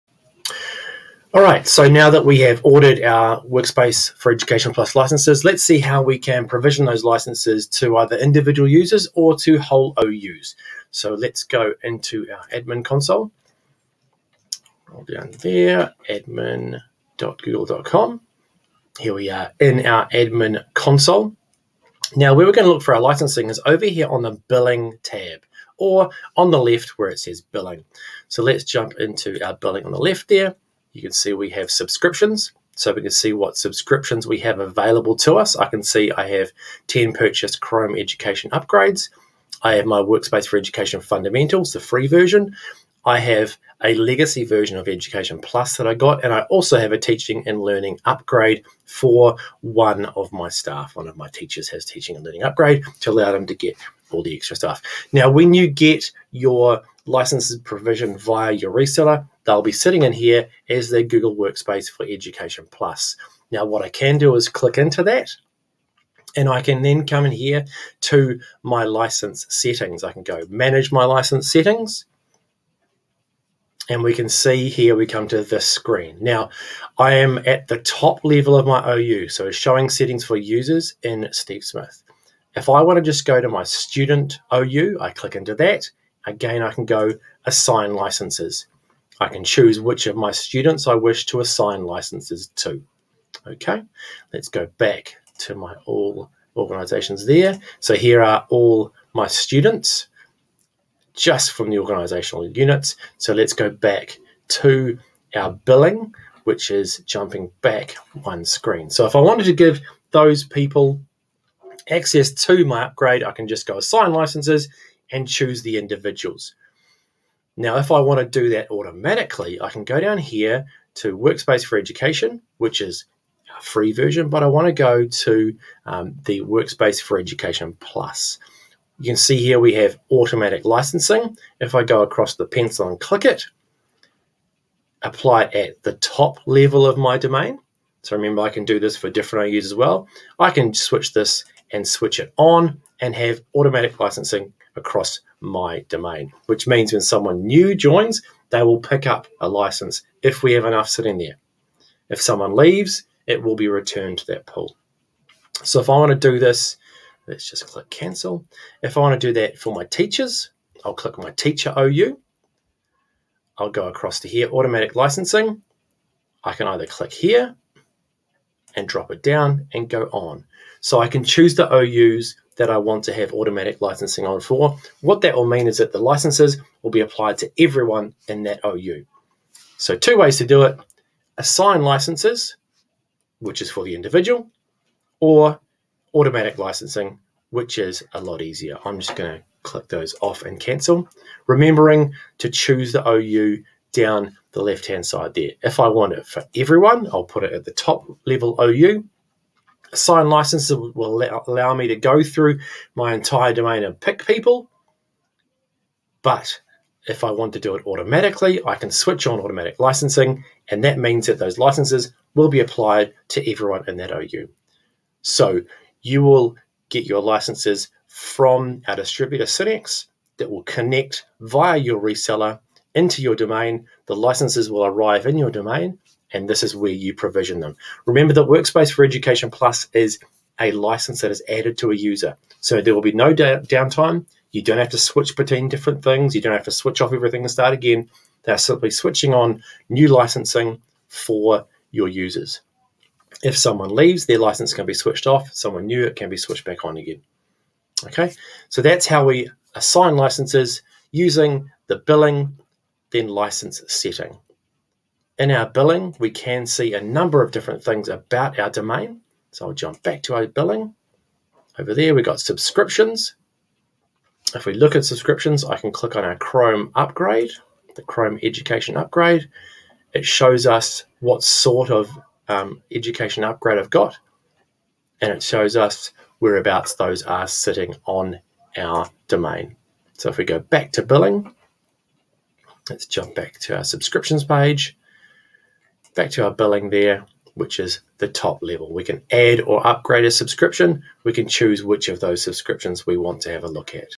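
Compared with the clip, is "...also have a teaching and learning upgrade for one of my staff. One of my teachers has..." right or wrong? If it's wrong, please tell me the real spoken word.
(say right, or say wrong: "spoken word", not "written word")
right.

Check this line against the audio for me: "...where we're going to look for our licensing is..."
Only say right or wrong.
right.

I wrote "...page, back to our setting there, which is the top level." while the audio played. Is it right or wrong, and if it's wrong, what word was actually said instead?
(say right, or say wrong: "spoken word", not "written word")
wrong: "billing", not "setting".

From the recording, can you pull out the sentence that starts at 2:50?
So I can choose the OUs that I want to have automatic licensing on for.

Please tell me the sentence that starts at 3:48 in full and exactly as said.
Remember that Workspace for Education Plus is a license that is added to a user.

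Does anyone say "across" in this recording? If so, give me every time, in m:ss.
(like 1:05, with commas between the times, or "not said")
2:12, 2:24, 2:43.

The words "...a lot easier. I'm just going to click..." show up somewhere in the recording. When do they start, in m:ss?
3:08.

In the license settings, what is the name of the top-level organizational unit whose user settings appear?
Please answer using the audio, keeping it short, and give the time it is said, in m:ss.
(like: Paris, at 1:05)
Steve Smith, at 1:21.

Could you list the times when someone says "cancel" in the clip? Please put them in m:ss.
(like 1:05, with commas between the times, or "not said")
2:37, 3:10.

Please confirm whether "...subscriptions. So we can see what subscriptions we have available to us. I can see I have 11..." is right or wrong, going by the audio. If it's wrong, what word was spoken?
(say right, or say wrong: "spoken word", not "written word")
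wrong: "10", not "11".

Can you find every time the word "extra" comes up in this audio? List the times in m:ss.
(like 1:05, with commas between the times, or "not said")
0:54.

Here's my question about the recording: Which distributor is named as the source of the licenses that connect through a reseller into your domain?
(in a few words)
Synnex.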